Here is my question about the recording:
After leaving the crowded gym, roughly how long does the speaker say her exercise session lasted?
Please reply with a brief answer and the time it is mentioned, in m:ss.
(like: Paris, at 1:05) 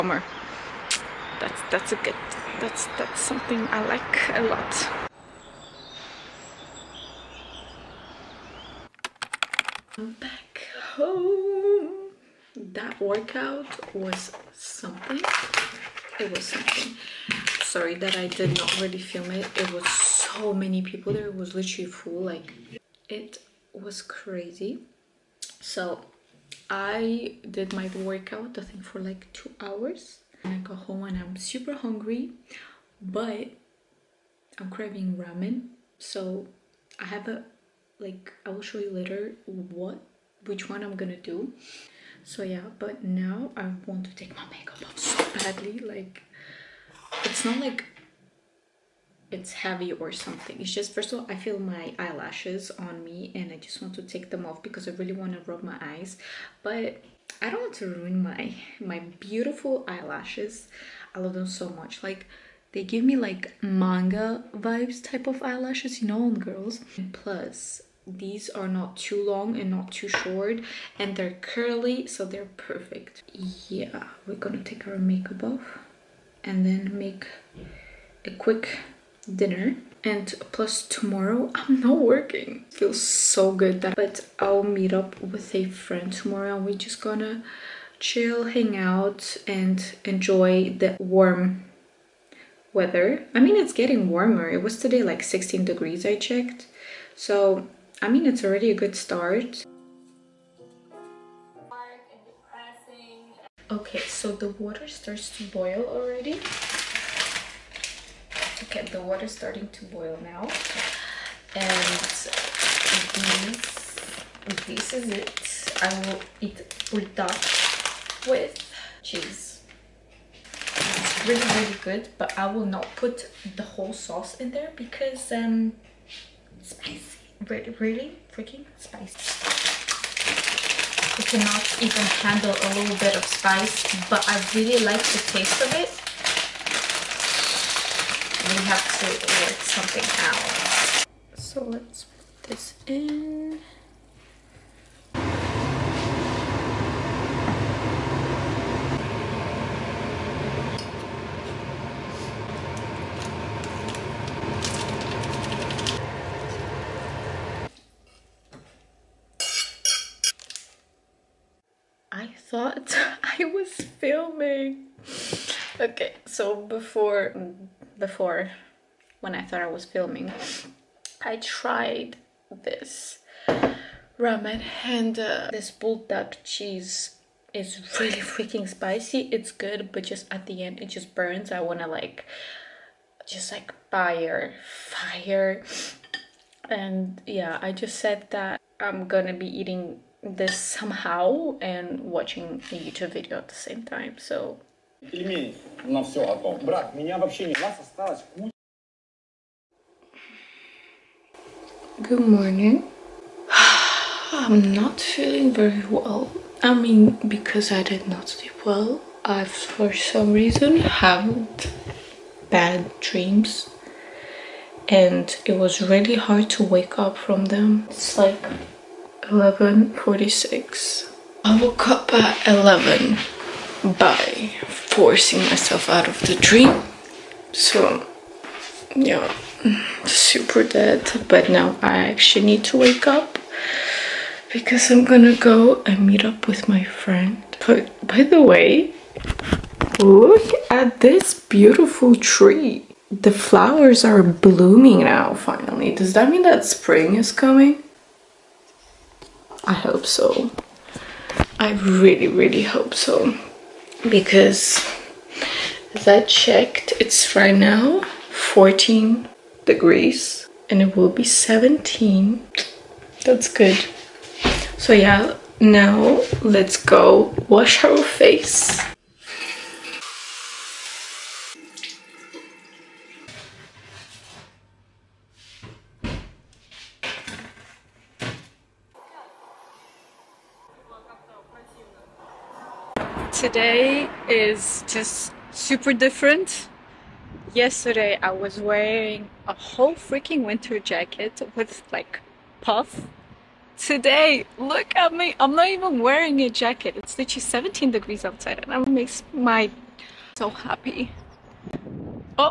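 2 hours, at 0:29.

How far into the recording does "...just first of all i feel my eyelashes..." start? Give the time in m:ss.
0:50.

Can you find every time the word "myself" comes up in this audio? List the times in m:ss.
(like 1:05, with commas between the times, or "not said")
3:45.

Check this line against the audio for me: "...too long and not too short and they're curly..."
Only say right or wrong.
right.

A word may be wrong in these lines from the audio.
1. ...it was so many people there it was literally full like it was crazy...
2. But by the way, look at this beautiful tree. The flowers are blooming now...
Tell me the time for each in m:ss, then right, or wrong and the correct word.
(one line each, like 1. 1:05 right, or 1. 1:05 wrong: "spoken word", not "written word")
1. 0:19 right
2. 3:57 right.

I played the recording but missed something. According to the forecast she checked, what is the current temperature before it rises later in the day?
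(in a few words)
14 degrees.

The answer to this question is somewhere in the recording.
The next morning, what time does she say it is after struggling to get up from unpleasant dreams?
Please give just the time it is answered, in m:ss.
3:39.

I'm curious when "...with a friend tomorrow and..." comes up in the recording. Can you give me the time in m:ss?
1:25.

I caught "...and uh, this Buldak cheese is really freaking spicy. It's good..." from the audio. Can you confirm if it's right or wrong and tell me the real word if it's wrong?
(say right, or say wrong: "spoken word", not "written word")
right.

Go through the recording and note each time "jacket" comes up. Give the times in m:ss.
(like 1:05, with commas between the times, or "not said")
4:50, 4:56.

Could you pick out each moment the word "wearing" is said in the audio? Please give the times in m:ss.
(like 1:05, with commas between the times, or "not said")
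4:48, 4:56.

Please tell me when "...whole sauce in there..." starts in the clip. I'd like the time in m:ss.
2:03.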